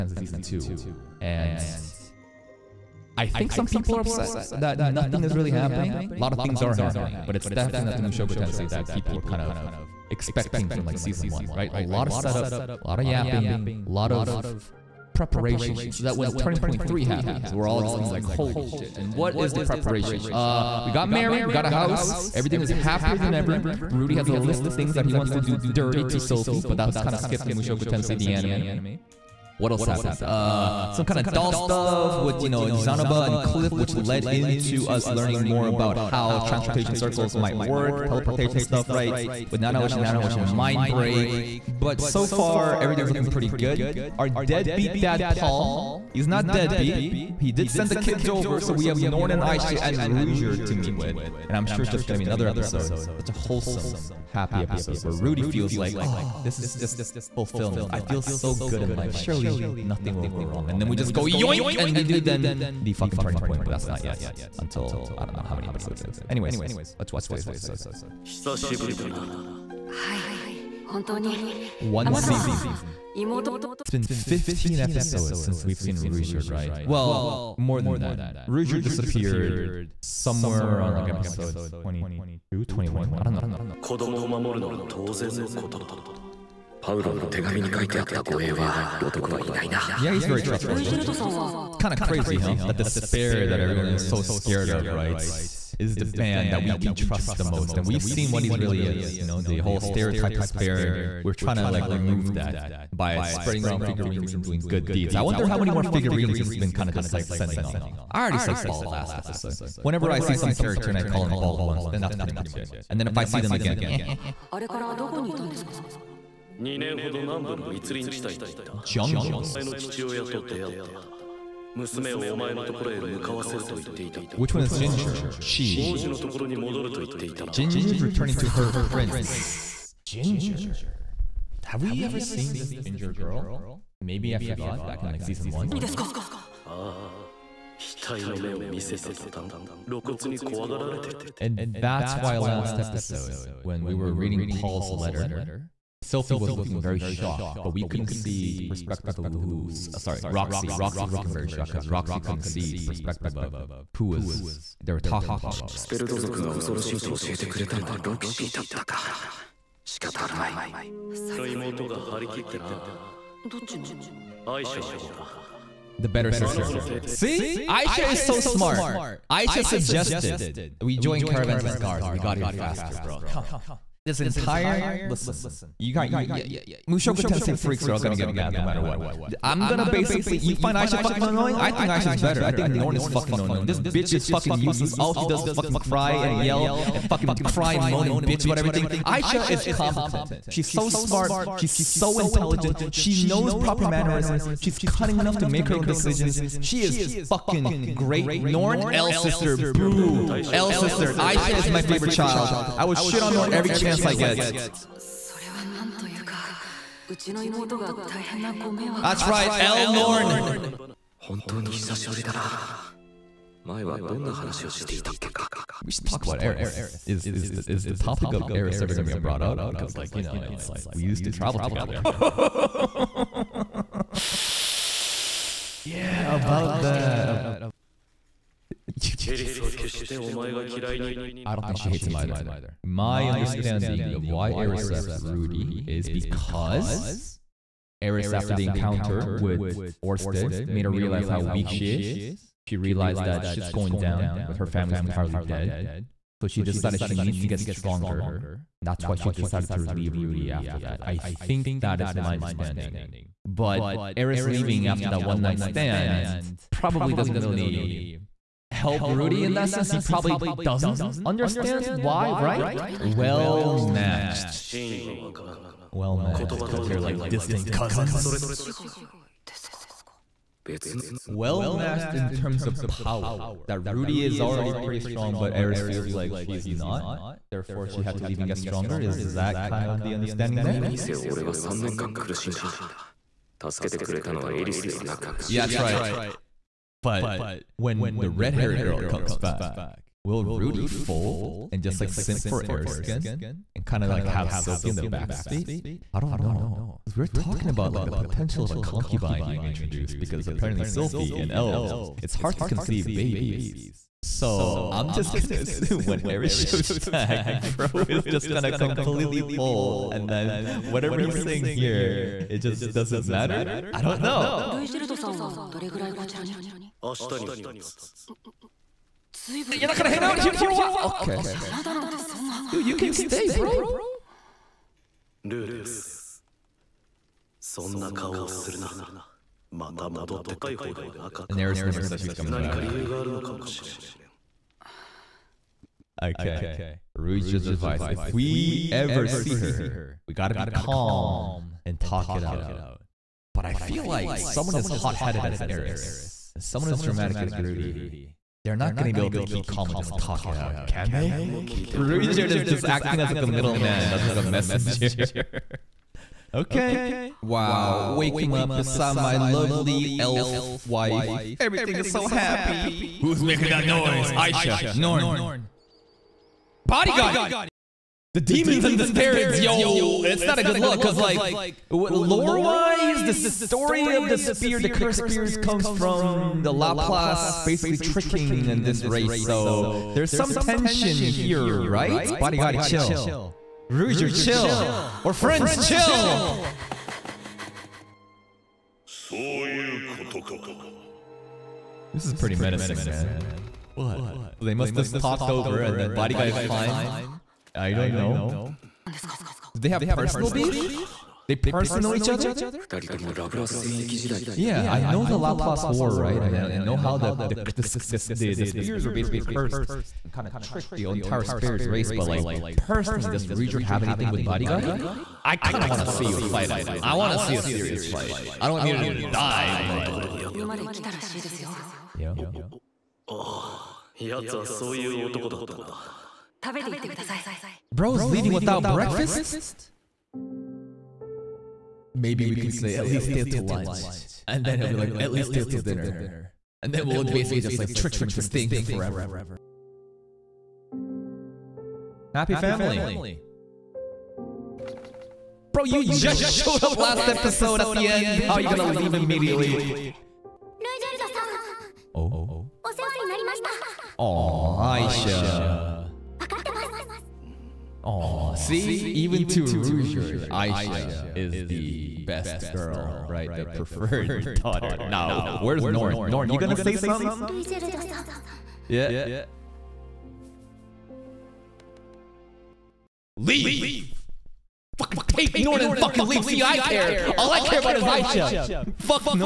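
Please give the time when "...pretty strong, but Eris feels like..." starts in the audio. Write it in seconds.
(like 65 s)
274 s.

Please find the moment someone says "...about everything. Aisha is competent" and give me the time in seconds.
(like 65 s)
188 s.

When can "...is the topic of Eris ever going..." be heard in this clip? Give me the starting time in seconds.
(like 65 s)
217 s.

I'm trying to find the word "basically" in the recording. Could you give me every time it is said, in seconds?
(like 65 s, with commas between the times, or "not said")
179 s, 377 s, 409 s, 437 s.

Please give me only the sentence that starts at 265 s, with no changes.
Well matched, because you're like distant cousins.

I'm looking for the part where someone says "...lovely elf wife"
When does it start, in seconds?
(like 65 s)
359 s.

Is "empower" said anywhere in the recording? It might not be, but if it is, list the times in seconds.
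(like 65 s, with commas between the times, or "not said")
not said.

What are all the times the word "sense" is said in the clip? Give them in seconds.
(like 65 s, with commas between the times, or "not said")
259 s.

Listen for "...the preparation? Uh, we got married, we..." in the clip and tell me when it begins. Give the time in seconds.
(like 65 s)
19 s.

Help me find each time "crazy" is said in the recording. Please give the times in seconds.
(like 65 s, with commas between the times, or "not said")
92 s.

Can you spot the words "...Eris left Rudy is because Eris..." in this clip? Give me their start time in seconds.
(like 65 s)
234 s.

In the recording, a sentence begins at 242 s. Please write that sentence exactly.
She realized that shit's going down, with her family's entirely dead.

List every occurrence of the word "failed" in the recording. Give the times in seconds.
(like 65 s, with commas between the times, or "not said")
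not said.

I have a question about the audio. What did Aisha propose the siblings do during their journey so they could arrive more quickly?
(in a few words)
Join caravans as guards.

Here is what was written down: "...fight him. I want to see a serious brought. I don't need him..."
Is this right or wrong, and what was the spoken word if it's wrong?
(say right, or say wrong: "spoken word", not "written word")
wrong: "fight", not "brought".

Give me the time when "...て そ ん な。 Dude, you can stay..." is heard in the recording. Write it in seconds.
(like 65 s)
322 s.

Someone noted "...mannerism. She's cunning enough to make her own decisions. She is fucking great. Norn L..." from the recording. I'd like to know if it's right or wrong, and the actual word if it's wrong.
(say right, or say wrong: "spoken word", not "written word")
right.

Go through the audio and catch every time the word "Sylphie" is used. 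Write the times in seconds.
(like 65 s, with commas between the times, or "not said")
300 s.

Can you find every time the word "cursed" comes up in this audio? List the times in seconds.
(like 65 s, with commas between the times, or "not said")
374 s, 409 s.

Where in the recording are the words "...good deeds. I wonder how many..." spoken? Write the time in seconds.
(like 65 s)
104 s.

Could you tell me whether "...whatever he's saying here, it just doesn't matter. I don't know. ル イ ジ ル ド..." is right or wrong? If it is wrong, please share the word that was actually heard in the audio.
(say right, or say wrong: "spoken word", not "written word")
right.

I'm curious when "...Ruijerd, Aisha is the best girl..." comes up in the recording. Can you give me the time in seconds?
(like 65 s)
459 s.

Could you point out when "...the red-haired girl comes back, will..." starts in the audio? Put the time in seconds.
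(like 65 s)
288 s.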